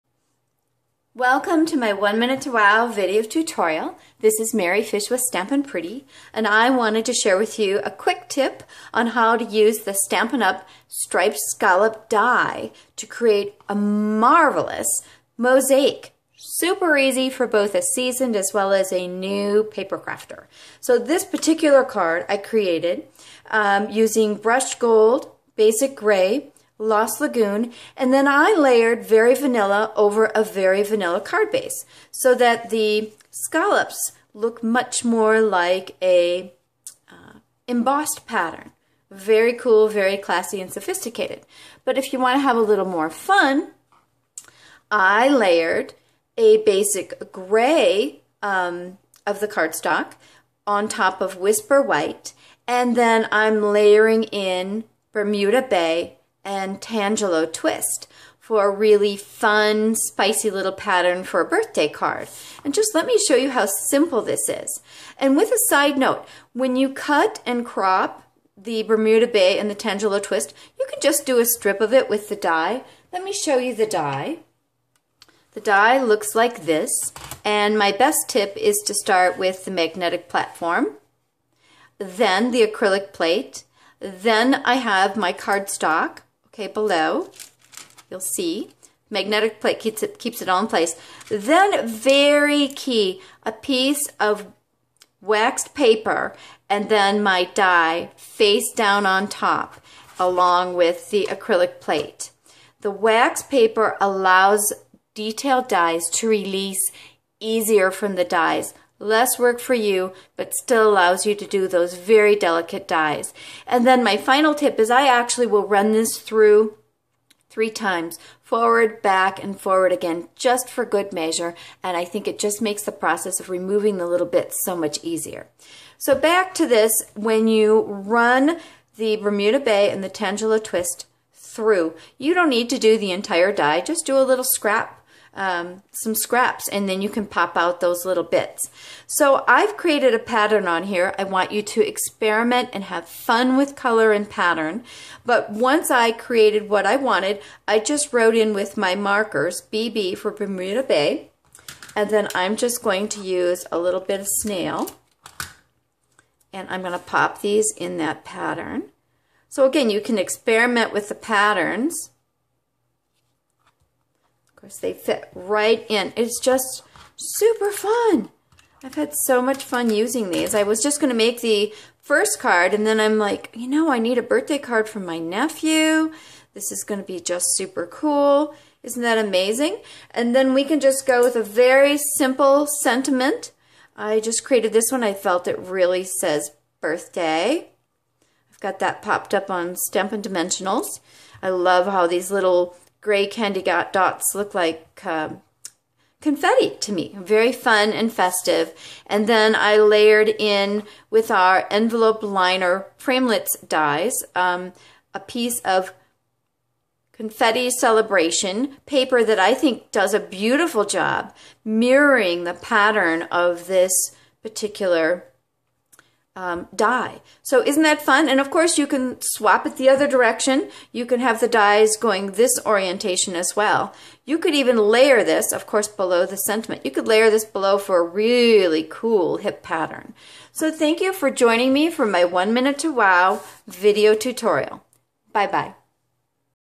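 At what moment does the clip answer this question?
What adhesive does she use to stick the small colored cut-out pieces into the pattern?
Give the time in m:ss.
2:34.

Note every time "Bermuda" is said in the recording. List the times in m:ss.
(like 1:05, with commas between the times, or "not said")
0:55, 1:08, 2:09, 2:30.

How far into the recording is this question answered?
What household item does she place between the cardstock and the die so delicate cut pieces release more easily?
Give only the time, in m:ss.
1:35.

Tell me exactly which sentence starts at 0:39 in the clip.
Very cool, very classy and sophisticated.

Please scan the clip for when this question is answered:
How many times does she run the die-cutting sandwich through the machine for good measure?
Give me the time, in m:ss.
1:57.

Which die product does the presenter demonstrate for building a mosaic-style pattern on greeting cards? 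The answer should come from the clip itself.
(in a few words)
Striped Scallop Die.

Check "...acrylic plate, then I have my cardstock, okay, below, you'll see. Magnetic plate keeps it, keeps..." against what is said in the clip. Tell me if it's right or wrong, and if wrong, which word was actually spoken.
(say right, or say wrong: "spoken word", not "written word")
right.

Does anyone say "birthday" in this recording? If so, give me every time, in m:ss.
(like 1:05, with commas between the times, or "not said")
1:01, 2:54, 3:06.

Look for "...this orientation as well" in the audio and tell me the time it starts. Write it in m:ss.
3:42.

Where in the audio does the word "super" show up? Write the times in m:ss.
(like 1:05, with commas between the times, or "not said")
0:16, 2:47, 2:57.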